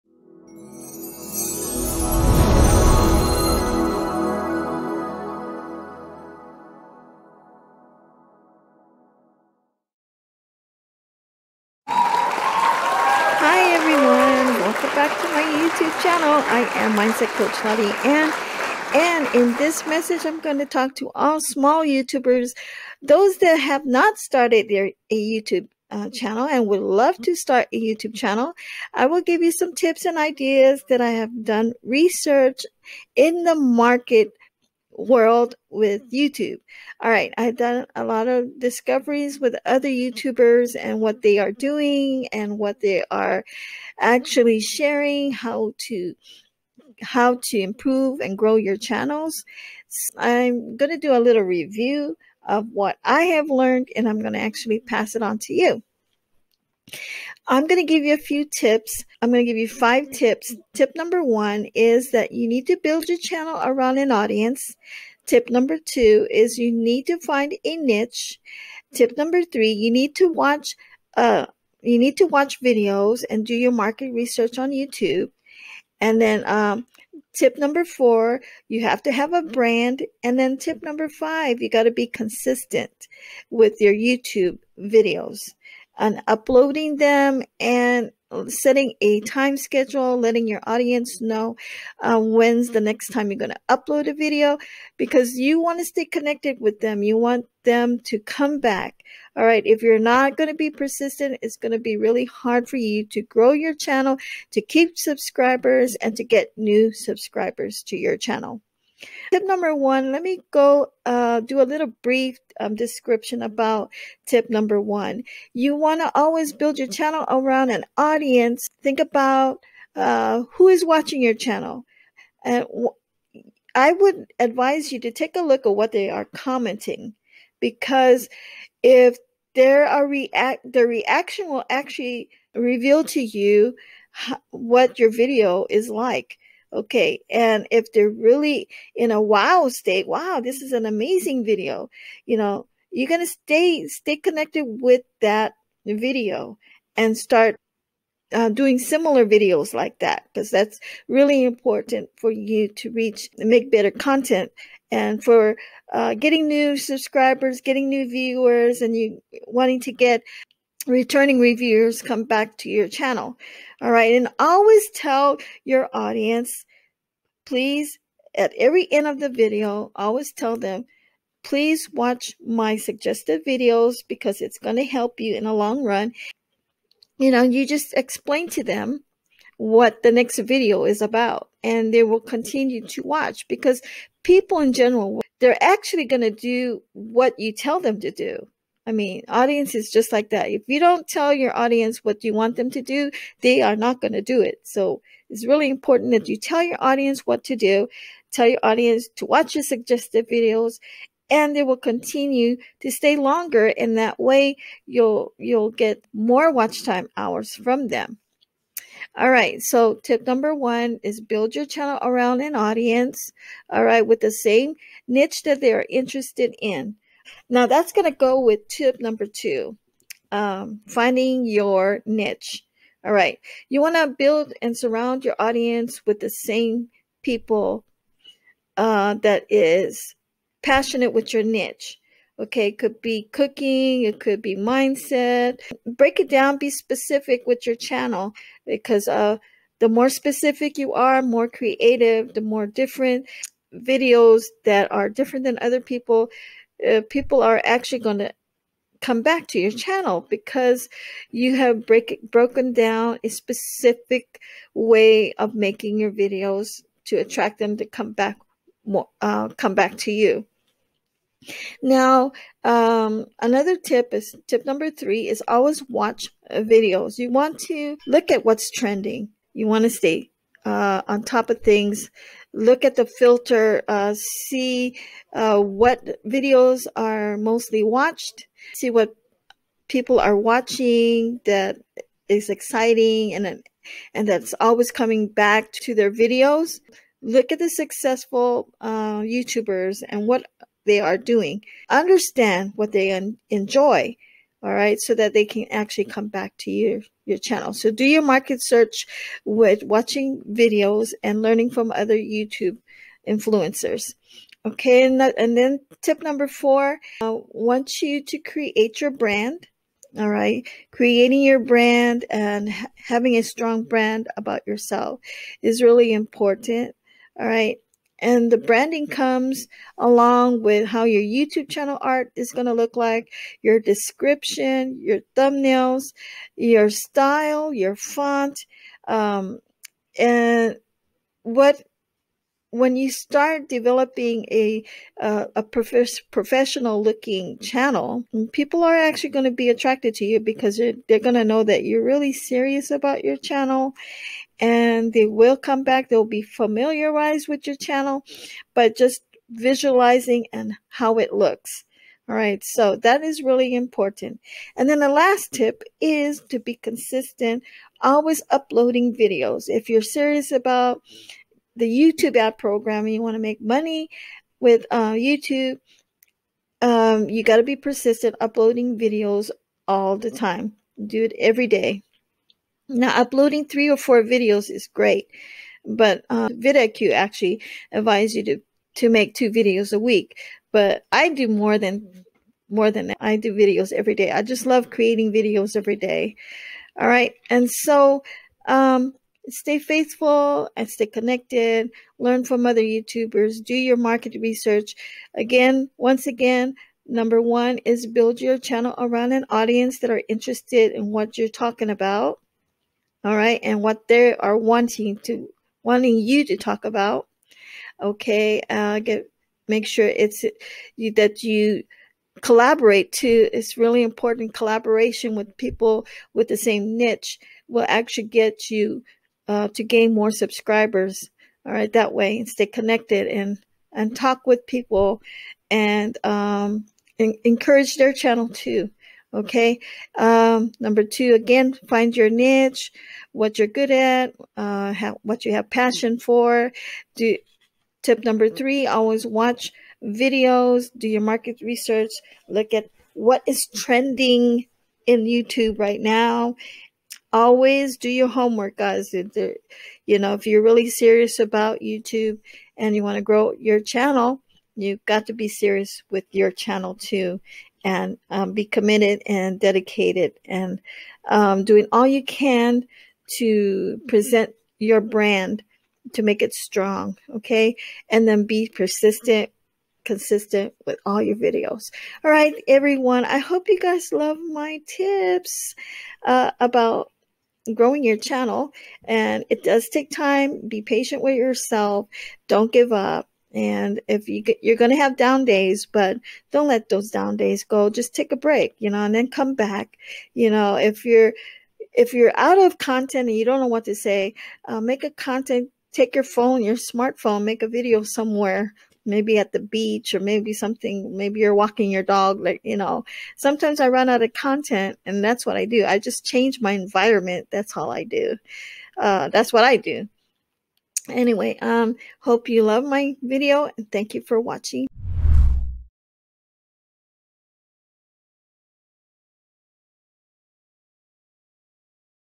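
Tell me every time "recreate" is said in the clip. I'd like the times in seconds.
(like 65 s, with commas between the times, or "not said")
not said.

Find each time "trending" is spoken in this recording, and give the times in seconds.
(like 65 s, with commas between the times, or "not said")
268 s, 443 s.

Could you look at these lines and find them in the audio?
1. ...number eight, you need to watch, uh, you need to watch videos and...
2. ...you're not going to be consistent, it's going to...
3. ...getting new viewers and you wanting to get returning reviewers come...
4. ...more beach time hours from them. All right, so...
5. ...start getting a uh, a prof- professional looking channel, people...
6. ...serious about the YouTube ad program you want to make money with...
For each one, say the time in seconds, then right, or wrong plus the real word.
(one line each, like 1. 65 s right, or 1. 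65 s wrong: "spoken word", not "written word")
1. 69 s wrong: "three", not "eight"
2. 99 s wrong: "persistent", not "consistent"
3. 157 s right
4. 206 s wrong: "watch", not "beach"
5. 333 s wrong: "developing", not "getting"
6. 360 s right.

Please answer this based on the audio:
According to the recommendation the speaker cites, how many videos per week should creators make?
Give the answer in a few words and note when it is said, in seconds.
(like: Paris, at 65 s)
2, at 379 s.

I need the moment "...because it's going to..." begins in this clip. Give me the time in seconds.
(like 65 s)
174 s.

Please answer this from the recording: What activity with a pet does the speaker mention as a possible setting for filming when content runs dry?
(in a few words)
Walking your dog.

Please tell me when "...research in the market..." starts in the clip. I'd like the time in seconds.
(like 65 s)
31 s.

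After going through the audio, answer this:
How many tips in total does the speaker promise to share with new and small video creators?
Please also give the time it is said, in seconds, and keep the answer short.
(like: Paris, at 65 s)
5, at 59 s.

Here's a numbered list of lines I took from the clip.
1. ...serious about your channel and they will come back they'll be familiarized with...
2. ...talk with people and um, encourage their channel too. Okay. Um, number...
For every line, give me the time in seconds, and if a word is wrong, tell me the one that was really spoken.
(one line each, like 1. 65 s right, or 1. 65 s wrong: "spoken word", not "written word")
1. 342 s right
2. 424 s right.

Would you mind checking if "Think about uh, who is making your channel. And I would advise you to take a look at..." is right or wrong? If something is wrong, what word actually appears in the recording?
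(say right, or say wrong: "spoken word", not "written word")
wrong: "watching", not "making".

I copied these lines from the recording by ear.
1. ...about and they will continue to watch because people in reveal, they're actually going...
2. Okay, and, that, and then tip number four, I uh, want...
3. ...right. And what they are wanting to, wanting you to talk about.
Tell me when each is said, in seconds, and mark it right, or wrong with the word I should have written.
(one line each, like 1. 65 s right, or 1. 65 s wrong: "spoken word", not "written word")
1. 181 s wrong: "general", not "reveal"
2. 304 s right
3. 403 s right.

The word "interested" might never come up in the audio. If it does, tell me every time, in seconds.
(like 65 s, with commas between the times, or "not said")
215 s, 400 s.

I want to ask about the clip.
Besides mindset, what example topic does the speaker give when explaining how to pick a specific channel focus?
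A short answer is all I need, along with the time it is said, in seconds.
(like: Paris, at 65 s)
Cooking, at 233 s.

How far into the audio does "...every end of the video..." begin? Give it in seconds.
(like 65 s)
168 s.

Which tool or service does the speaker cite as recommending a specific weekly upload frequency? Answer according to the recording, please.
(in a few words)
vidIQ.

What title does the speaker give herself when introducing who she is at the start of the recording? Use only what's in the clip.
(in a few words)
Mindset Coach.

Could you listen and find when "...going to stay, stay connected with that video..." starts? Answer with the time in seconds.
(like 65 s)
143 s.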